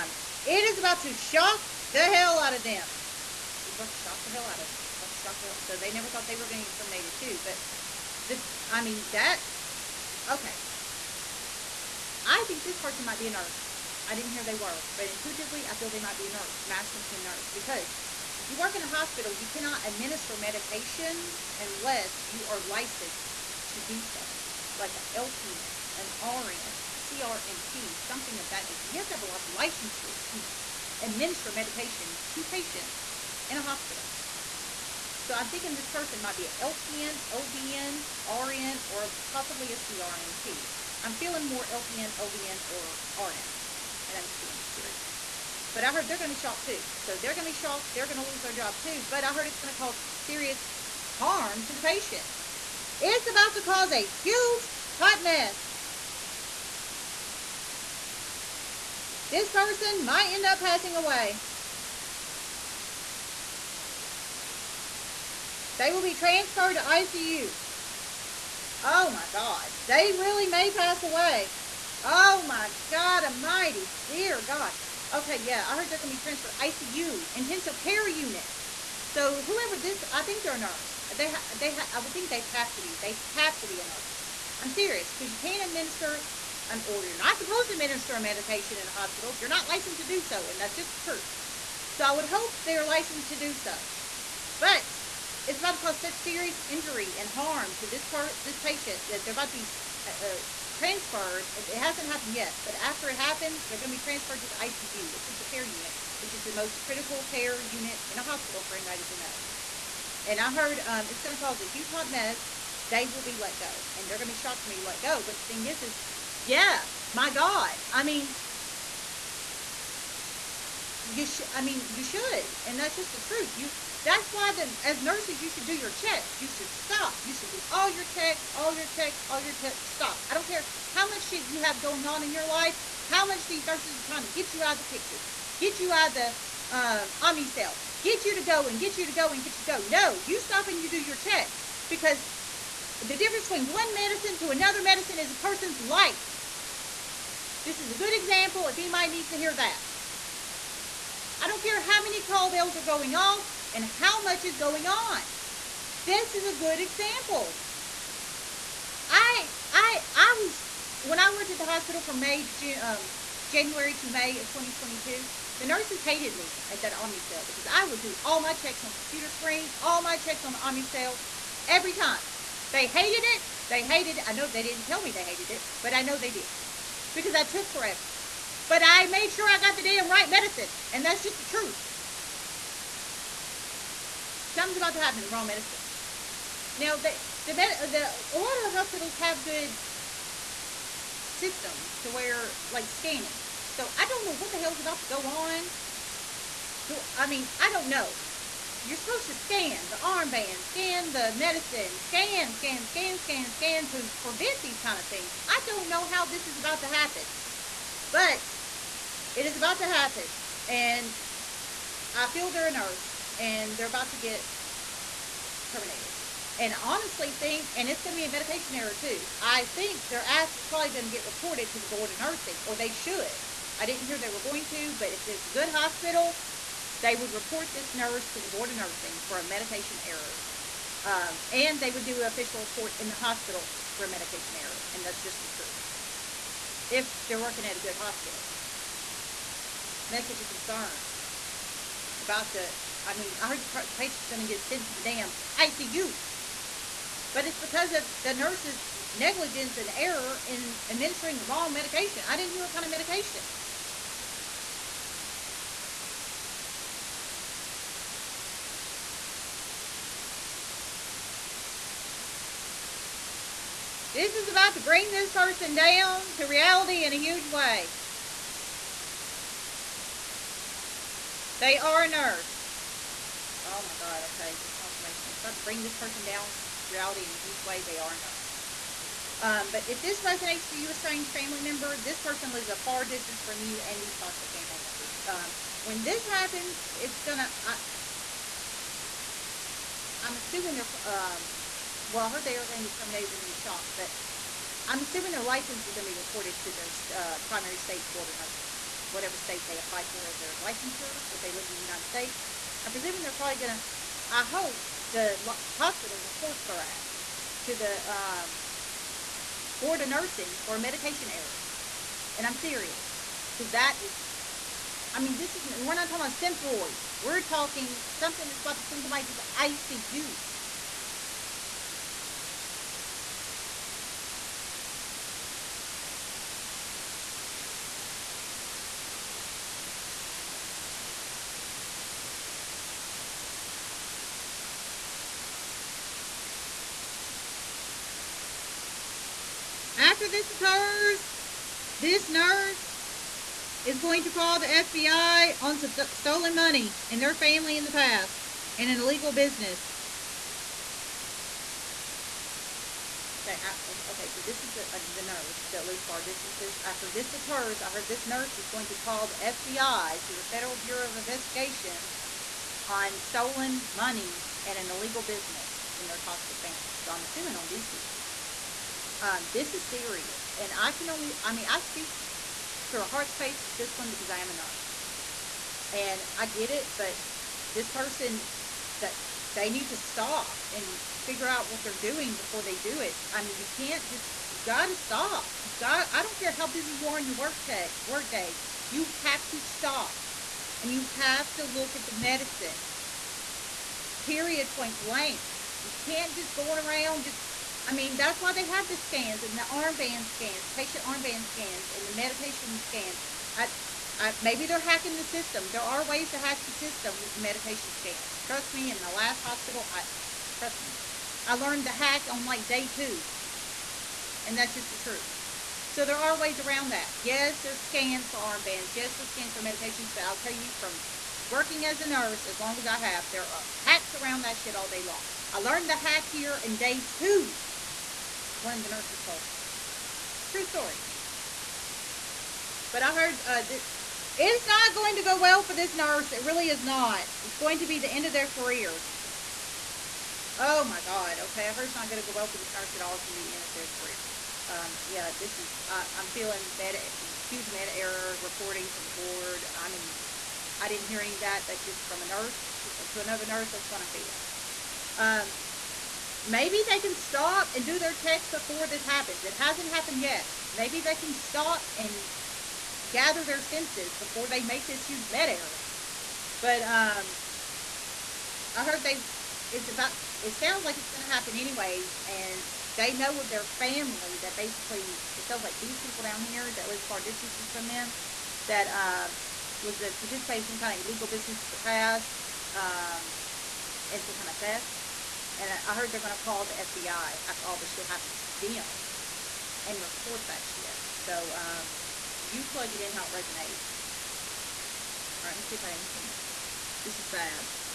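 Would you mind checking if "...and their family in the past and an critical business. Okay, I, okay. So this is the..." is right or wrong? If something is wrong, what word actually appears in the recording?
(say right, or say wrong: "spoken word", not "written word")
wrong: "illegal", not "critical".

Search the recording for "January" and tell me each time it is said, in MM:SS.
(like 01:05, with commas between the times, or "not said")
02:43.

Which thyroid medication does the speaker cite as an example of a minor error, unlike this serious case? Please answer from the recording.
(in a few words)
Synthroid.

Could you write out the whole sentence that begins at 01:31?
So I would hope they're licensed to do so.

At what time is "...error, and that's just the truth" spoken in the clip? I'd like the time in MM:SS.
03:54.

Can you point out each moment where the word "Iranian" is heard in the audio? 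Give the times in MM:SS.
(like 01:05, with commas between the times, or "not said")
not said.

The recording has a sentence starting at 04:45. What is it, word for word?
Um, when this happens, it's gonna.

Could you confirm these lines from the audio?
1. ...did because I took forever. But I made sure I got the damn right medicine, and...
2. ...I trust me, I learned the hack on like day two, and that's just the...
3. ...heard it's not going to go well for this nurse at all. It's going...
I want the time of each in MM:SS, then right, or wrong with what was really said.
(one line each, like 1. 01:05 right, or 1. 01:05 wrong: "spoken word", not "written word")
1. 02:56 right
2. 06:49 right
3. 07:21 right.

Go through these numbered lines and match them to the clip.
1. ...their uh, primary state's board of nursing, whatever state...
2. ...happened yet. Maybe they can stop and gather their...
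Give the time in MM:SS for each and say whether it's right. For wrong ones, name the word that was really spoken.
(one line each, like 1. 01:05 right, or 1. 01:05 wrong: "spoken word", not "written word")
1. 04:56 right
2. 07:39 right.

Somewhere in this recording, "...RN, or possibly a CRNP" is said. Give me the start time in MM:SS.
00:38.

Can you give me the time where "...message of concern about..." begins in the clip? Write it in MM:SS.
04:00.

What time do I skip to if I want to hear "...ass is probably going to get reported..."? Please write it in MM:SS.
03:40.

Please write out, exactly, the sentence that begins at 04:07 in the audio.
But it's because of the nurse's negligence and error in administering the wrong medication.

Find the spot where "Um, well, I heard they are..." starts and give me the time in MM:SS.
04:51.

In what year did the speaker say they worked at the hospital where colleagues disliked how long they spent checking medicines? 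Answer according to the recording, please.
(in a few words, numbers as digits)
2022.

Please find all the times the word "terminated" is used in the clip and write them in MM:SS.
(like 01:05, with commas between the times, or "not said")
00:06, 03:35, 04:52.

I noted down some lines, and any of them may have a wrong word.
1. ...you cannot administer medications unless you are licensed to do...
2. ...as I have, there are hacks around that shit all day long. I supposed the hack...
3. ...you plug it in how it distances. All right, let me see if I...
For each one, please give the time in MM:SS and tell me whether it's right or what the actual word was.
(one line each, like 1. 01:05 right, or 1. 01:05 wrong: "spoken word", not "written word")
1. 00:19 right
2. 07:02 wrong: "learned", not "supposed"
3. 08:12 wrong: "resonates", not "distances".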